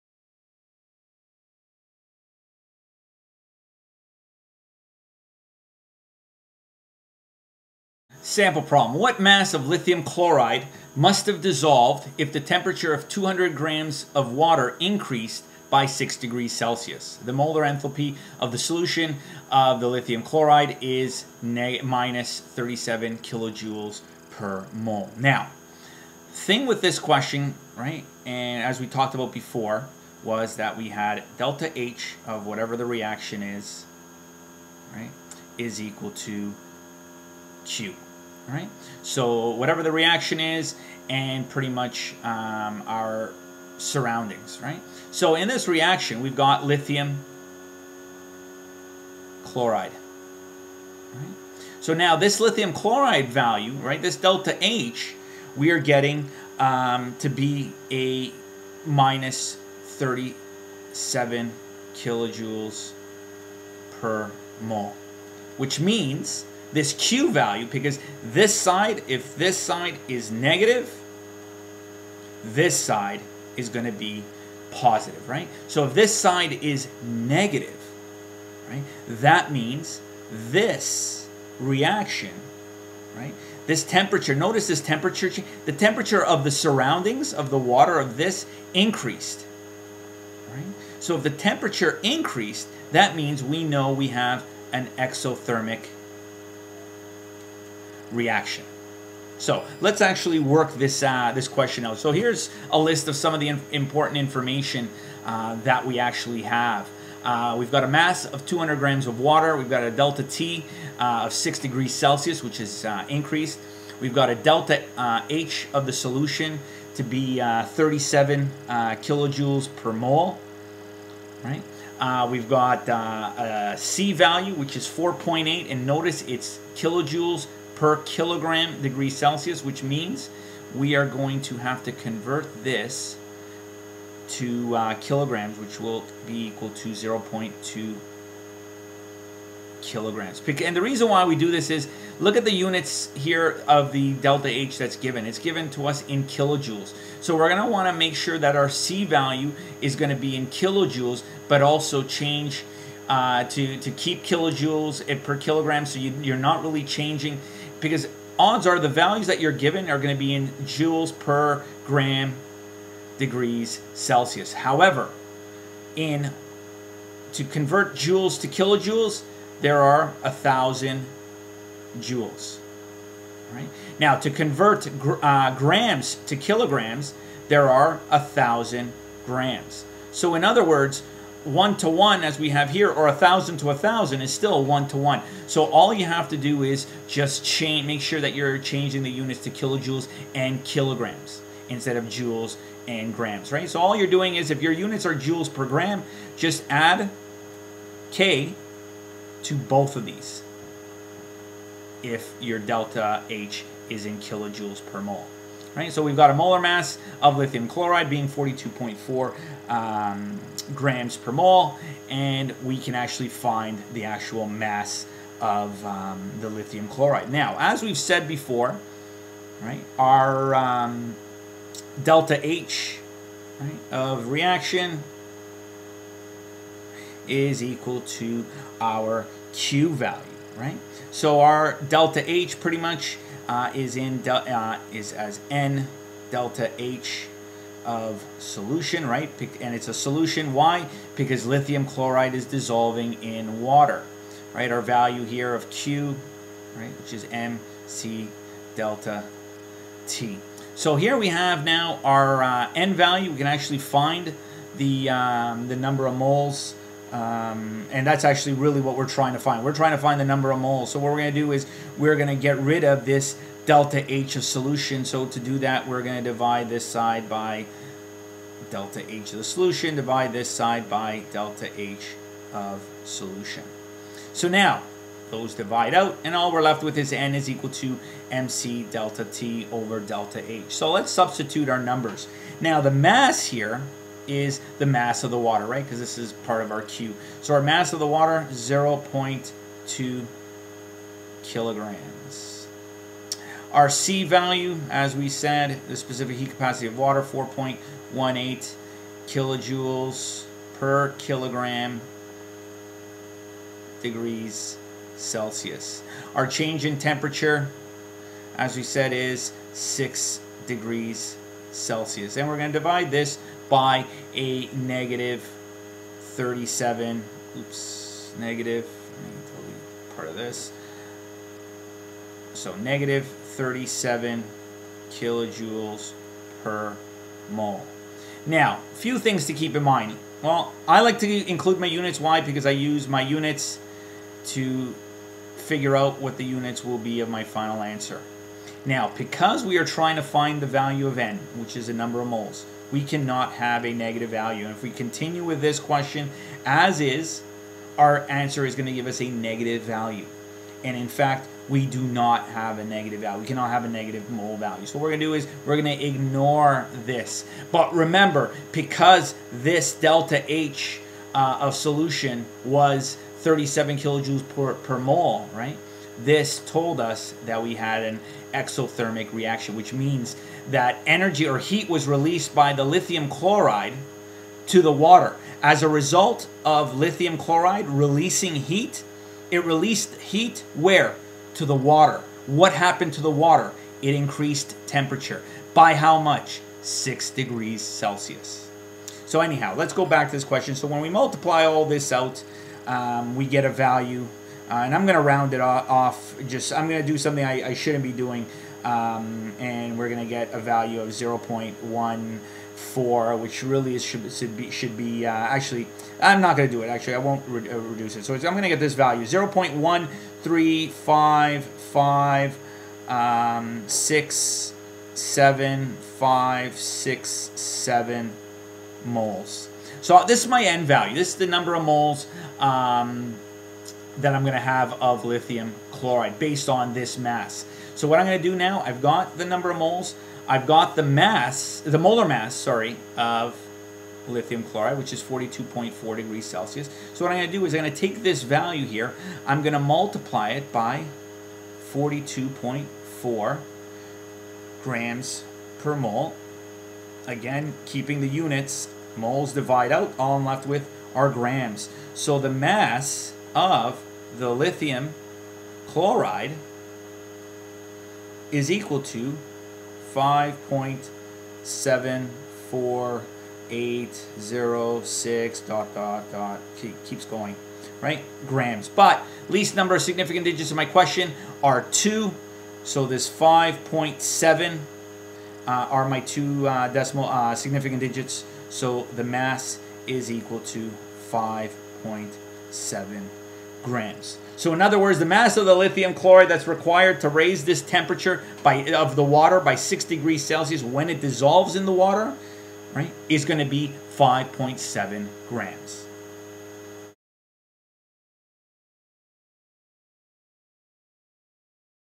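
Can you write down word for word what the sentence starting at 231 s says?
So our delta H pretty much uh, is in uh, is as n delta H of solution, right?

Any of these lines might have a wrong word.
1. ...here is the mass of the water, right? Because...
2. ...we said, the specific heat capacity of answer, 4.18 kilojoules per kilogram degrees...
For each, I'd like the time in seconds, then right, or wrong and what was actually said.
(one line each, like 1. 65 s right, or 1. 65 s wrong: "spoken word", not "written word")
1. 283 s right
2. 295 s wrong: "water", not "answer".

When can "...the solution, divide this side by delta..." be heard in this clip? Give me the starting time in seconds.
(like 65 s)
269 s.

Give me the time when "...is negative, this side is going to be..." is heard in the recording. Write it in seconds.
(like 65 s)
70 s.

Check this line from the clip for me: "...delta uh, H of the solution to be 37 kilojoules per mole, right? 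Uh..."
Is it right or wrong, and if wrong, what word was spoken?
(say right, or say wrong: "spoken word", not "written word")
right.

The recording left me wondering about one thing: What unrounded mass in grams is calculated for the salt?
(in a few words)
5.74806 g.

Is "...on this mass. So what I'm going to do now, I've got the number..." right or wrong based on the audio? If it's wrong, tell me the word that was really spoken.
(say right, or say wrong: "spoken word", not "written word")
right.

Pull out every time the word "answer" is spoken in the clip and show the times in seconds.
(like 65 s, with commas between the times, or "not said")
337 s, 348 s.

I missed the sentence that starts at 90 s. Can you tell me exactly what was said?
So if the temperature increased, that means we know we have an exothermic reaction.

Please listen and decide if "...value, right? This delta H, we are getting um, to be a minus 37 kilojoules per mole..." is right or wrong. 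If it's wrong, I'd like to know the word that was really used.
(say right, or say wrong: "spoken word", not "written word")
right.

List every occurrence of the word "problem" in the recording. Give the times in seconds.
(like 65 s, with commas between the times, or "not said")
8 s.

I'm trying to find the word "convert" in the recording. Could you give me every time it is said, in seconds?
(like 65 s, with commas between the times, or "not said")
131 s, 167 s, 174 s.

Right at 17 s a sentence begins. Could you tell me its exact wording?
The molar enthalpy of the solution of the lithium chloride is minus 37 kilojoules per mole.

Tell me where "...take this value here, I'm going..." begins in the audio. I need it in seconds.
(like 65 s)
437 s.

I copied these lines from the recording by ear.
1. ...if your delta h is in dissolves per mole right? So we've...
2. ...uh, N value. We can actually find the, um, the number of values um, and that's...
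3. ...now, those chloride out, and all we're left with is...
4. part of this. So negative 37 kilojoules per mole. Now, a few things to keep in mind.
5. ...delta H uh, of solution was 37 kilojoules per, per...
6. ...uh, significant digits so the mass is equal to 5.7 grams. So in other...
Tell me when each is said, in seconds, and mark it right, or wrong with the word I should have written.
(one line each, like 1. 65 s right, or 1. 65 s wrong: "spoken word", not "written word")
1. 202 s wrong: "kilojoules", not "dissolves"
2. 252 s wrong: "moles", not "values"
3. 274 s wrong: "divide", not "chloride"
4. 320 s right
5. 359 s right
6. 477 s right.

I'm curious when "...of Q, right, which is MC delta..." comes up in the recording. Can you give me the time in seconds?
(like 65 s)
245 s.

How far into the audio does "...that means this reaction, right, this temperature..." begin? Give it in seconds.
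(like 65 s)
79 s.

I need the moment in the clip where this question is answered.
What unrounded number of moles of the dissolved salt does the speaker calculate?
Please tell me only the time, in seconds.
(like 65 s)
409 s.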